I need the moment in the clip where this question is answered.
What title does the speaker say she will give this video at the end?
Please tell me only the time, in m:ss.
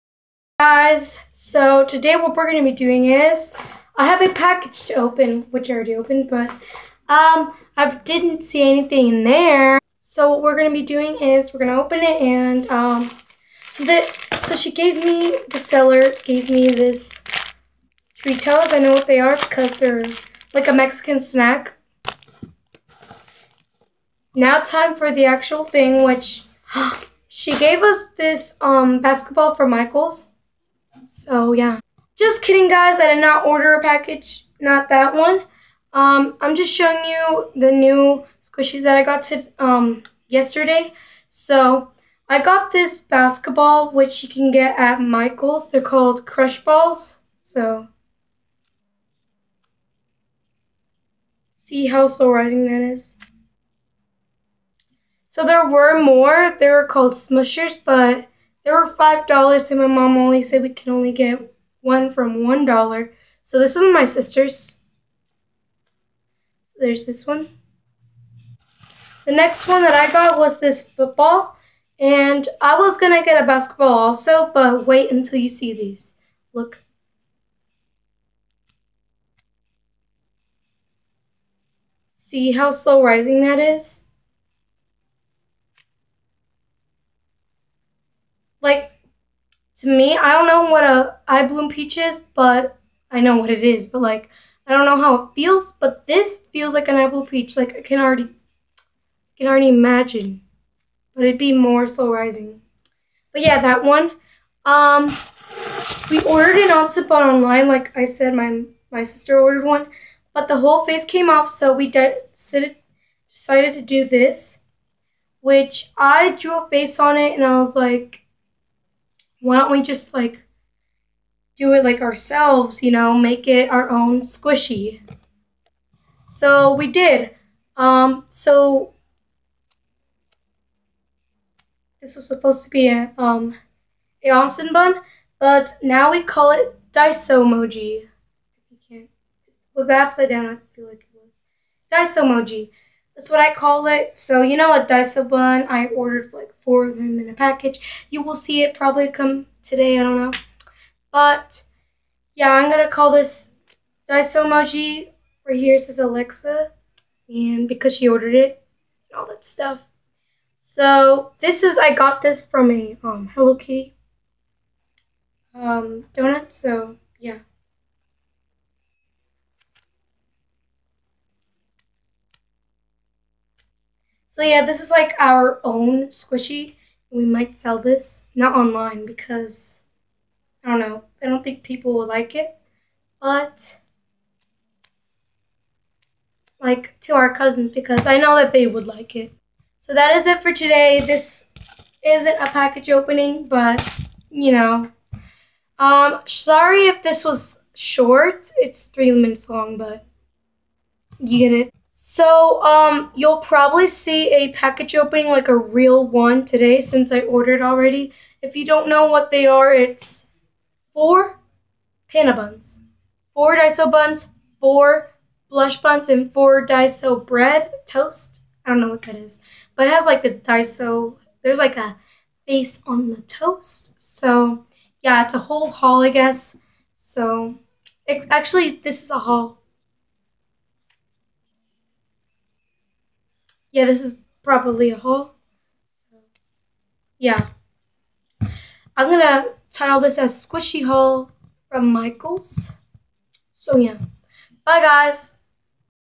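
4:00.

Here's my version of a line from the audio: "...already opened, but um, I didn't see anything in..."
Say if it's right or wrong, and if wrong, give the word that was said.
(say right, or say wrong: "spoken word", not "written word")
right.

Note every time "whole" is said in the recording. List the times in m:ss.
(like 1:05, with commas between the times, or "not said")
1:50, 3:45.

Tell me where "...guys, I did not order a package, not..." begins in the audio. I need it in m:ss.
0:32.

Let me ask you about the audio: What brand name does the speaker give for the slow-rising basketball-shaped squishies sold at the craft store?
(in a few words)
Crush Balls.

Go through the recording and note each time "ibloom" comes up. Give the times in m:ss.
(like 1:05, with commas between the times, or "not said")
1:31, 1:36.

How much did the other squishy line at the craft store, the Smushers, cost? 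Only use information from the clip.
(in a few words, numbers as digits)
5 dollars.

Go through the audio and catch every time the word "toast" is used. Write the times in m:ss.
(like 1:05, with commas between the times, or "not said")
3:37, 3:43.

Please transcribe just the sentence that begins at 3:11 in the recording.
This isn't a package opening, but you know.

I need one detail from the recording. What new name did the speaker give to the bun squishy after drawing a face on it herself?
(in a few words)
Daiso Moji.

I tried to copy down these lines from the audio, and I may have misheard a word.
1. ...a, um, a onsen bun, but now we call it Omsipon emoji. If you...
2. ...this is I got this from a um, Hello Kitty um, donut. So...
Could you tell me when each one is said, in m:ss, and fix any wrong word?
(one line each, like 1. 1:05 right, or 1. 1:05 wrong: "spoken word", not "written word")
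1. 2:12 wrong: "Daiso", not "Omsipon"
2. 2:41 right.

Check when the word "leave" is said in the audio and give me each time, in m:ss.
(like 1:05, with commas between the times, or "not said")
not said.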